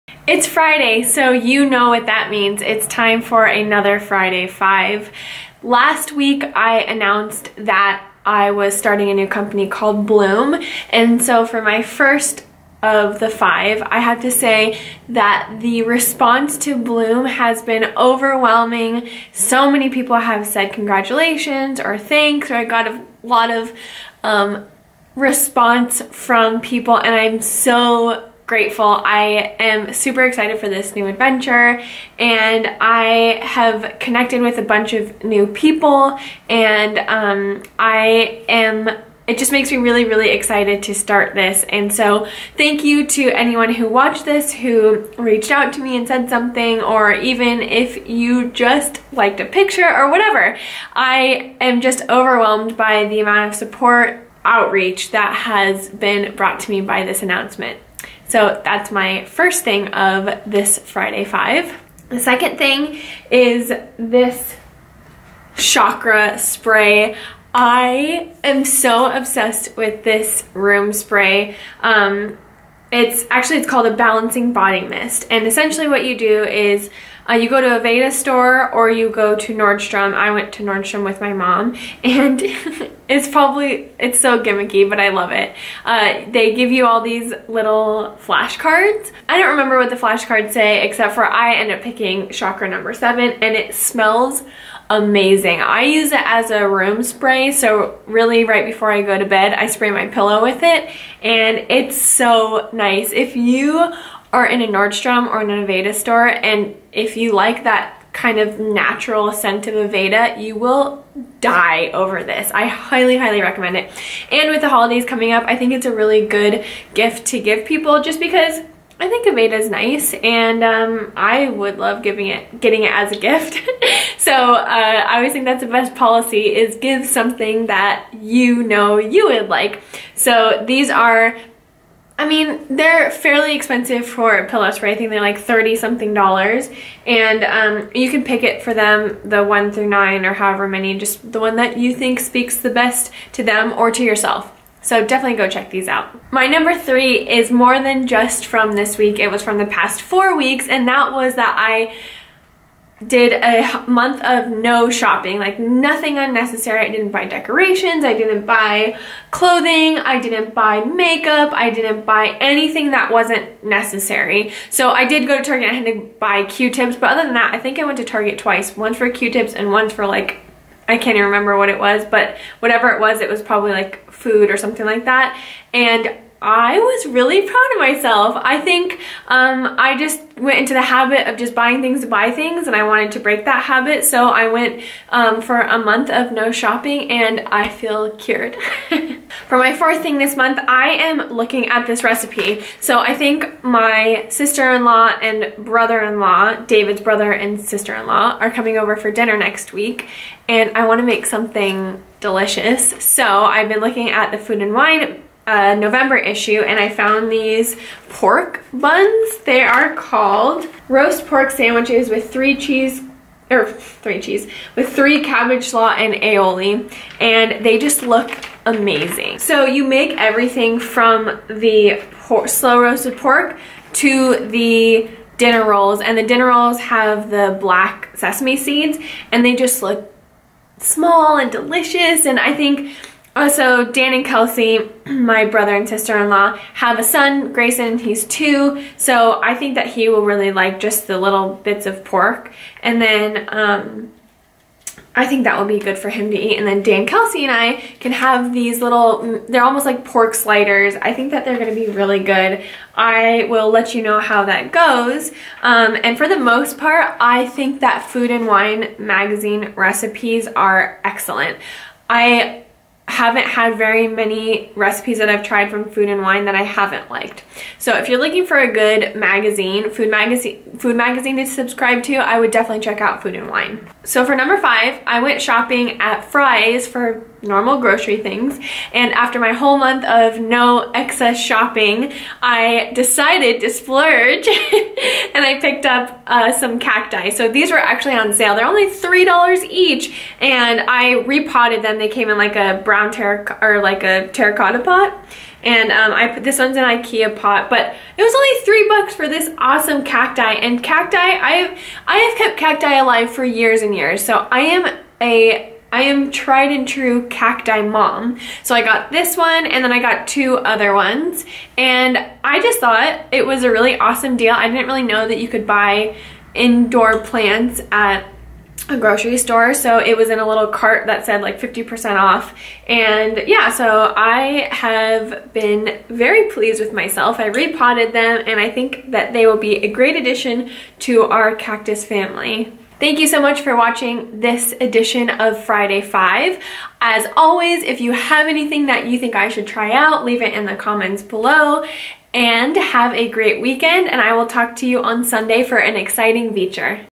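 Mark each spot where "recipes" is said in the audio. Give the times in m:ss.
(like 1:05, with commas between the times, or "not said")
3:12, 4:19, 4:24.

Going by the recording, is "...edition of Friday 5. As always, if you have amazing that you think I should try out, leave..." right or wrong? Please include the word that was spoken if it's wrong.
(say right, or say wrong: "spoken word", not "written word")
wrong: "anything", not "amazing".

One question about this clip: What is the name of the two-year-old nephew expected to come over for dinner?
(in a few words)
Grayson.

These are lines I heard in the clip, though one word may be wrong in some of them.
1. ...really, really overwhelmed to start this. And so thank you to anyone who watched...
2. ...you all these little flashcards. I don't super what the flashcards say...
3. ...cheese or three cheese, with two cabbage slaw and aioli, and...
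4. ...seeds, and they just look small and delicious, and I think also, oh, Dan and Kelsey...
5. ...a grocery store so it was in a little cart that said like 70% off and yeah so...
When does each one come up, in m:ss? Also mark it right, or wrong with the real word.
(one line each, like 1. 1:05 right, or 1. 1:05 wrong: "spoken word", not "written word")
1. 0:39 wrong: "excited", not "overwhelmed"
2. 1:26 wrong: "remember", not "super"
3. 3:32 wrong: "three", not "two"
4. 3:48 right
5. 5:18 wrong: "50", not "70".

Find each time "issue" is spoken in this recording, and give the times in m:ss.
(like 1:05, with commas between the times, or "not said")
3:26.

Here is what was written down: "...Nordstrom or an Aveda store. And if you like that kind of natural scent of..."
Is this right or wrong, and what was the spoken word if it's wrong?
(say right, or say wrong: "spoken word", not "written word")
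right.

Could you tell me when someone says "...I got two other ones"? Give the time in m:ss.
5:09.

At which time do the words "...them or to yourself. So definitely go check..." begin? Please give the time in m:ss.
2:23.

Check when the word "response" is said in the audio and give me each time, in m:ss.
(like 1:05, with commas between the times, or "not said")
0:15, 0:25.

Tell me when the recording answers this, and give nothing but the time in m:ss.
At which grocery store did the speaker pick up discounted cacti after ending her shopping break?
4:36.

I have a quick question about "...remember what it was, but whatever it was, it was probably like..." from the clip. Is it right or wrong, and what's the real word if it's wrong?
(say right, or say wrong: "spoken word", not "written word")
right.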